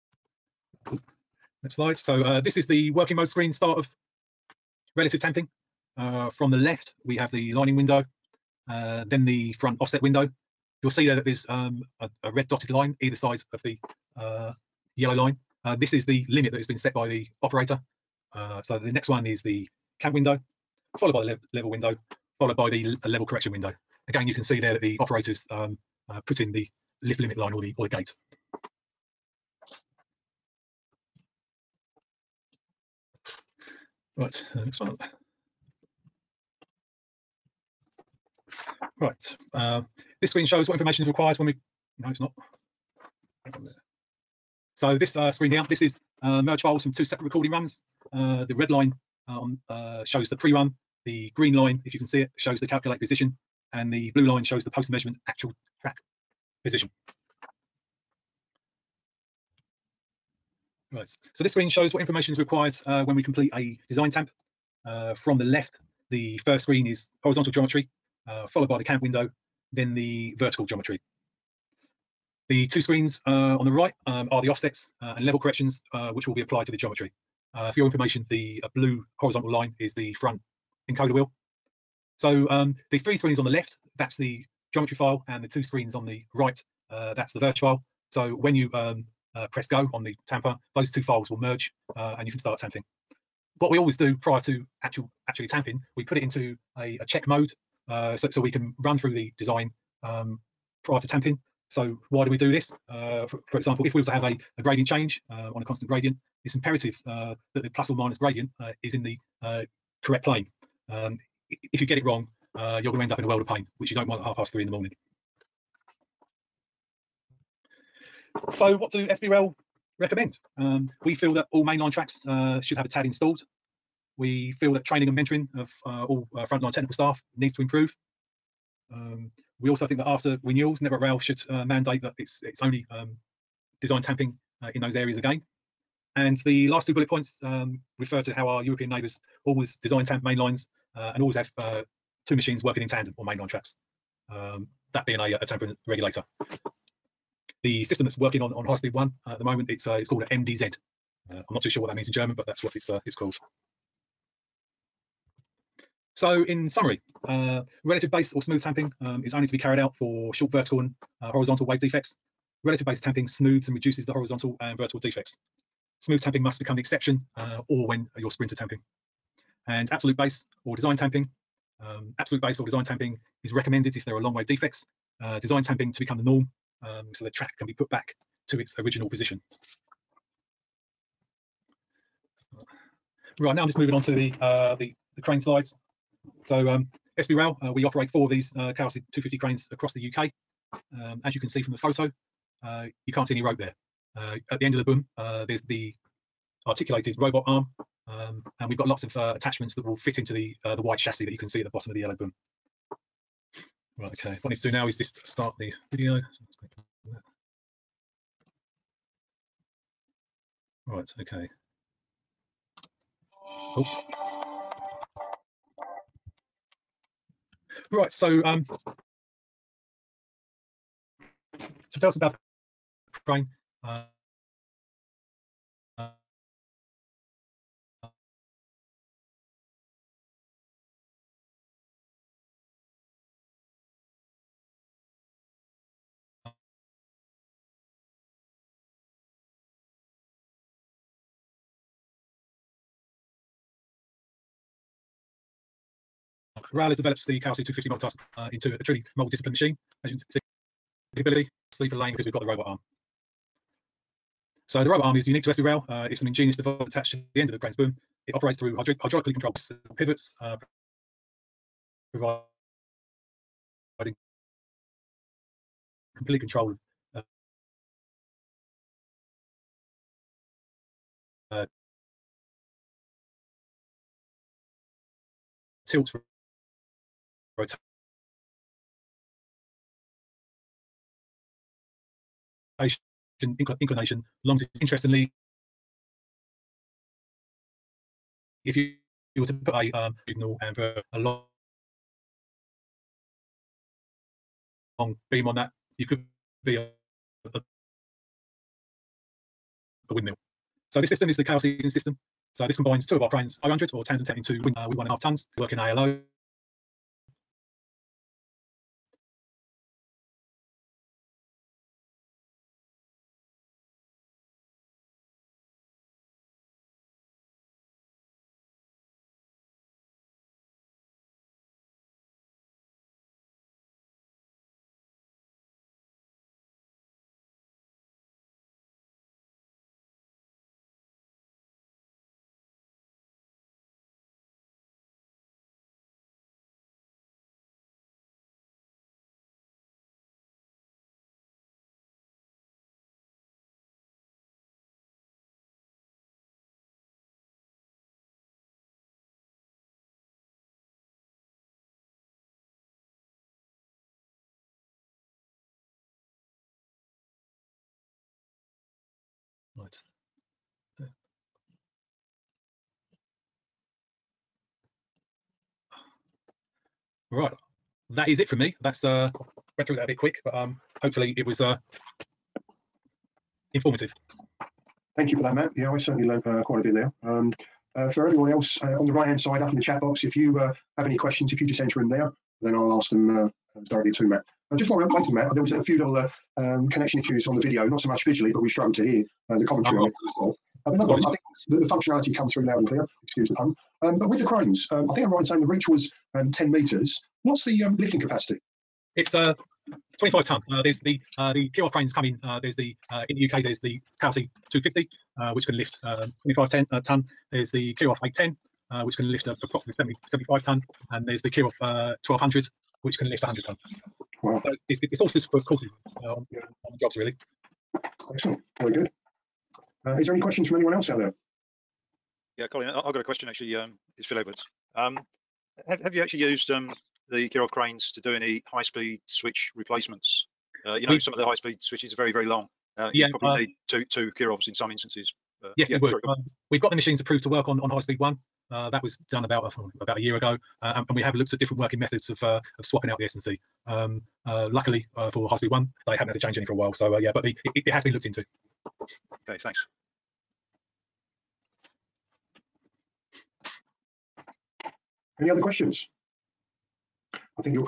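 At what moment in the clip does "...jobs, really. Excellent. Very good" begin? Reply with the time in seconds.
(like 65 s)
417 s.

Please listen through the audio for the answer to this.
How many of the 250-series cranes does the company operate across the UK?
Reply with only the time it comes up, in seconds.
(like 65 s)
188 s.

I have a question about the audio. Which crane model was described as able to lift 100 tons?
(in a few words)
Kirow 1200.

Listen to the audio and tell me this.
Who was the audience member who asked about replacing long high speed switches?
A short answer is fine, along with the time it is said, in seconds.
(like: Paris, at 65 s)
Phil Edwards, at 424 s.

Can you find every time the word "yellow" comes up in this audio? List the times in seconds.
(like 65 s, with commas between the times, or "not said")
14 s, 201 s.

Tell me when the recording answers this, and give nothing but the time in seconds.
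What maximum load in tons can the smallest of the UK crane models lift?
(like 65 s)
400 s.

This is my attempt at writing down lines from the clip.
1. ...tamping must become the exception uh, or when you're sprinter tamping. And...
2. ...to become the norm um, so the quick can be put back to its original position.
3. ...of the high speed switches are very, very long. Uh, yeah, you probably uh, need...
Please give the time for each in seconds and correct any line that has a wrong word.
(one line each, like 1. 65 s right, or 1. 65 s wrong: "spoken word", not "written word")
1. 166 s right
2. 175 s wrong: "track", not "quick"
3. 431 s right.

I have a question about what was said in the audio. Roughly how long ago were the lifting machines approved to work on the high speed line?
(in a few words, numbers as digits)
About a year ago.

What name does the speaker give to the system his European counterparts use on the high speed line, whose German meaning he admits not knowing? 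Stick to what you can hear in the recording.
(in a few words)
MDZ.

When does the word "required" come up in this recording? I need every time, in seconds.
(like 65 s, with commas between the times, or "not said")
41 s, 62 s.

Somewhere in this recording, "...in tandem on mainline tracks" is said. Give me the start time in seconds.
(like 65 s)
142 s.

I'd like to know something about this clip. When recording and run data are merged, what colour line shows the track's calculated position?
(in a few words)
Green.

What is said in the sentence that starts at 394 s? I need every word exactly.
Um, but with the cranes, um, I think I'm right in saying the reach was um, 10 metres.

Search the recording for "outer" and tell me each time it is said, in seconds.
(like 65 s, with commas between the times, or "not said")
not said.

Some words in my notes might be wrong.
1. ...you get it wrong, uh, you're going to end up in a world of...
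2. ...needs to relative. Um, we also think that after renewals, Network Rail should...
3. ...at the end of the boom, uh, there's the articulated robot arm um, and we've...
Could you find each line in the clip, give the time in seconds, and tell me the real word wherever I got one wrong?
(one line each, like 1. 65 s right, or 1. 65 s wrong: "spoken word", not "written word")
1. 111 s right
2. 127 s wrong: "improve", not "relative"
3. 194 s right.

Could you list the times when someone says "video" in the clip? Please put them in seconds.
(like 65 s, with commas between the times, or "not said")
205 s, 387 s.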